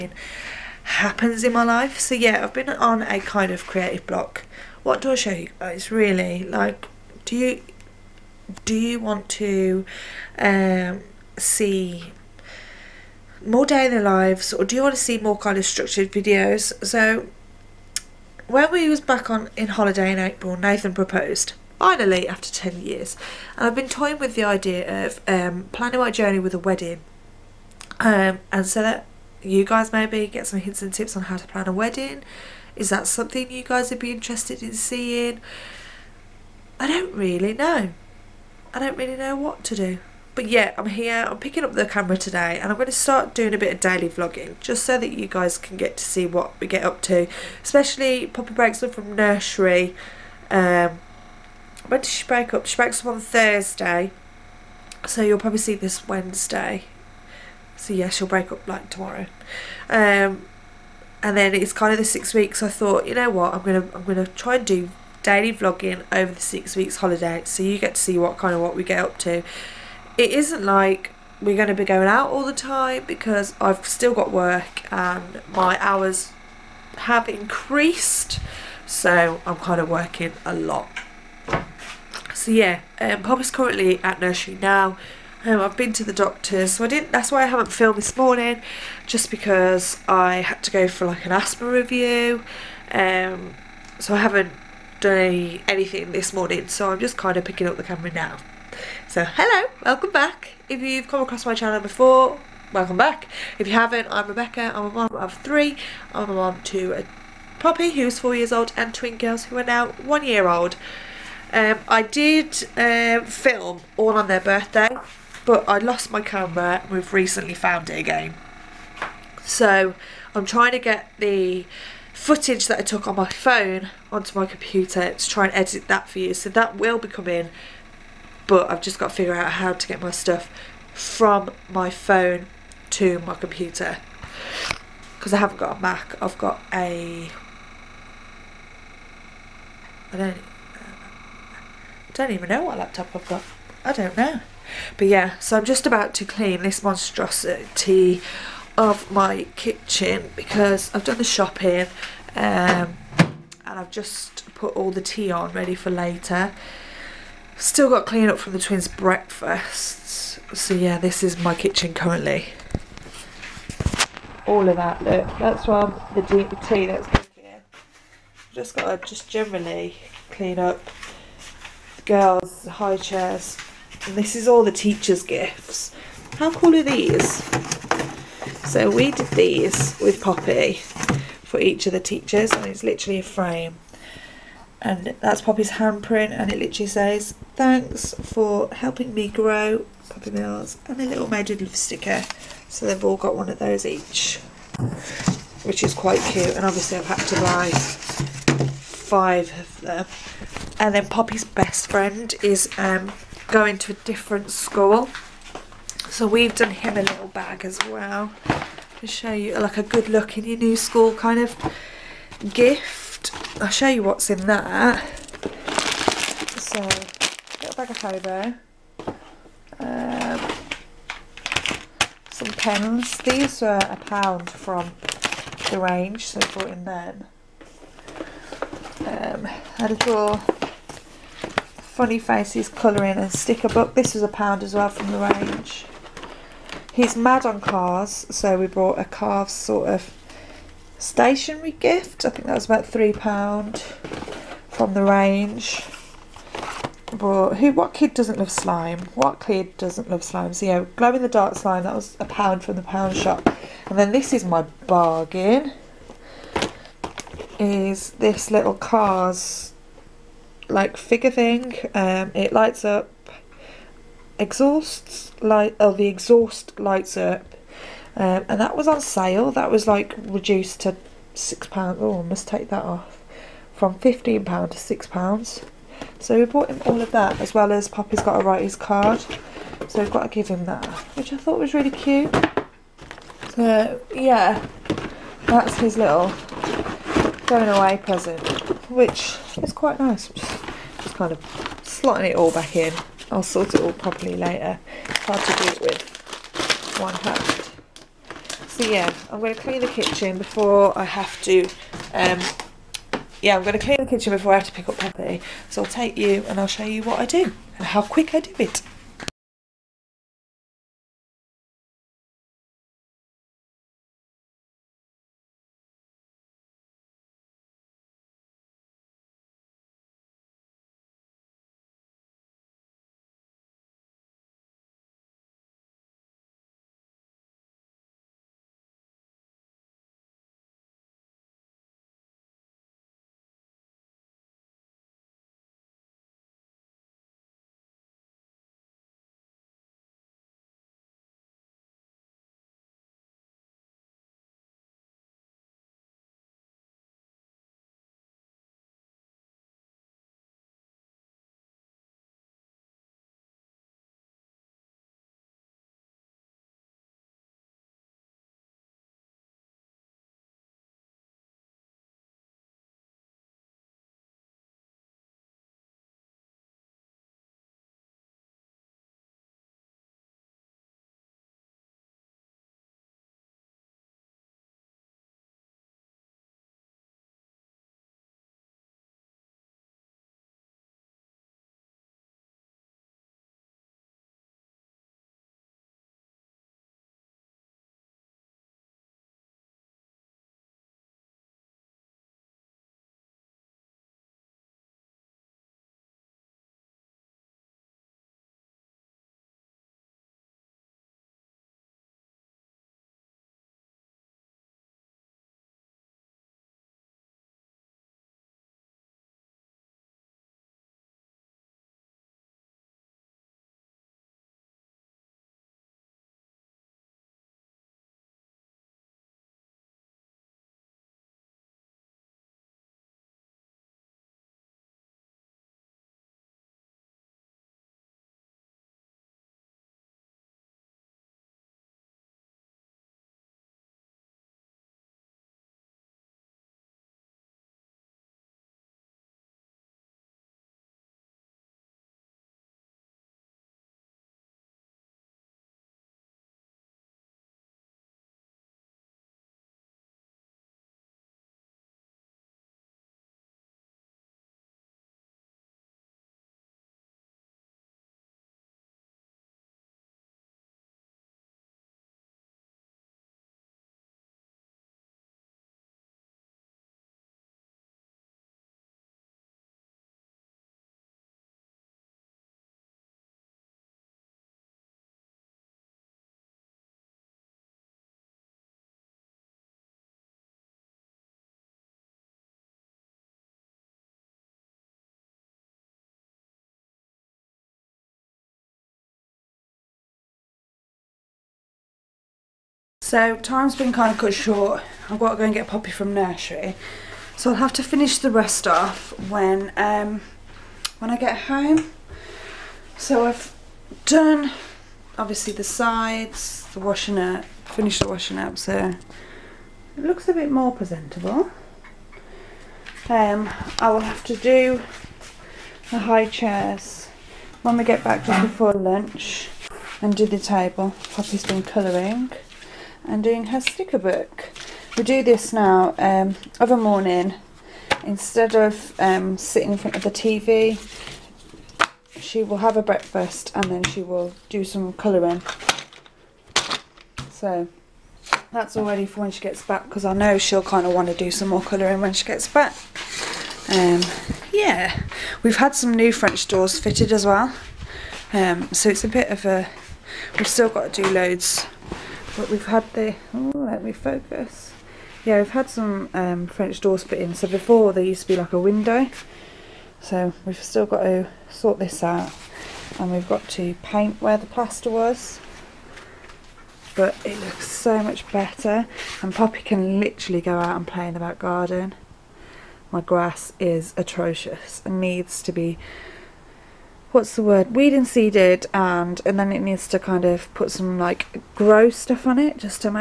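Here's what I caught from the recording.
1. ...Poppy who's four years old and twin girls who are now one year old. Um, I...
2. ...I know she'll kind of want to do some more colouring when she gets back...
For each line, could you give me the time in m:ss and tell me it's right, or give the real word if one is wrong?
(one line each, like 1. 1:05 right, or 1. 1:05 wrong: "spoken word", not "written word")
1. 1:47 right
2. 9:00 right.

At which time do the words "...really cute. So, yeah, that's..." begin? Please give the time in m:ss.
4:41.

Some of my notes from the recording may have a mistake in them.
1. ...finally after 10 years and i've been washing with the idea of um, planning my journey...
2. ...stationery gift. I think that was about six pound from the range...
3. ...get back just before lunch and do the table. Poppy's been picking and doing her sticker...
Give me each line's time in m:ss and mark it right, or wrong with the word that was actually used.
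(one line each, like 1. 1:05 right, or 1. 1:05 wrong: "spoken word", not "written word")
1. 0:21 wrong: "toying", not "washing"
2. 4:00 wrong: "three", not "six"
3. 8:37 wrong: "colouring", not "picking".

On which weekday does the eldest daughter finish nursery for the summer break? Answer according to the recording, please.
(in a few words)
Thursday.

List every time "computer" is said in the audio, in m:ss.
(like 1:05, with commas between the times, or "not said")
2:04, 2:13.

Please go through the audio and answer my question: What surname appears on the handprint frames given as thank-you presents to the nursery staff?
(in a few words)
Mills.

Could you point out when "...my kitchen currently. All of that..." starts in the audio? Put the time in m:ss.
2:41.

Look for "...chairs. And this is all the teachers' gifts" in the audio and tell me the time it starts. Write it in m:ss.
2:52.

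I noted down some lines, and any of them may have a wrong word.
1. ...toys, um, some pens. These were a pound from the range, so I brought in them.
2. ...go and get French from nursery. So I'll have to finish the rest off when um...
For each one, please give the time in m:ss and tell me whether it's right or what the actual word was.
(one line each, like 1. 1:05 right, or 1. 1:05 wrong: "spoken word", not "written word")
1. 3:37 right
2. 8:15 wrong: "Poppy", not "French".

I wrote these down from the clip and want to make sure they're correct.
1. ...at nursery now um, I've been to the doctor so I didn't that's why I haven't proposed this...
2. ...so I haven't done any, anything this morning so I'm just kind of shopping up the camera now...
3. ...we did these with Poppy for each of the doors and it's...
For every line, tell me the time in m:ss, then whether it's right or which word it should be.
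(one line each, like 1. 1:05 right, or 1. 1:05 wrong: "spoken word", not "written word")
1. 1:24 wrong: "filmed", not "proposed"
2. 1:33 wrong: "picking", not "shopping"
3. 2:58 wrong: "teachers", not "doors".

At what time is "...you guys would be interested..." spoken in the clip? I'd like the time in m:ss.
0:33.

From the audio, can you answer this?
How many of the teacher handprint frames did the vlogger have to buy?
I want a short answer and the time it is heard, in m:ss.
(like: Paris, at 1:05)
5, at 3:18.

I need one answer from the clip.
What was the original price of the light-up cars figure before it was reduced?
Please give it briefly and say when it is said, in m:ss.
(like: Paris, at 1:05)
15 pounds, at 4:33.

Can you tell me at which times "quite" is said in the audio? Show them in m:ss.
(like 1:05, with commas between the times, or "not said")
3:15, 4:49.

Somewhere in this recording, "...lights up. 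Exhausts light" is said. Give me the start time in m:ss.
4:22.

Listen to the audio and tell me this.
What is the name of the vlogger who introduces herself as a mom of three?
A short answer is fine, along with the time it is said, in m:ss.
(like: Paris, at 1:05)
Rebecca, at 1:44.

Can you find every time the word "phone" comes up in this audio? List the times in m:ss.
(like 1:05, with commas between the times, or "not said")
2:03, 2:11.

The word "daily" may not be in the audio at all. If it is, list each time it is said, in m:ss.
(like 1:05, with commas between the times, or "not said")
0:43, 1:05.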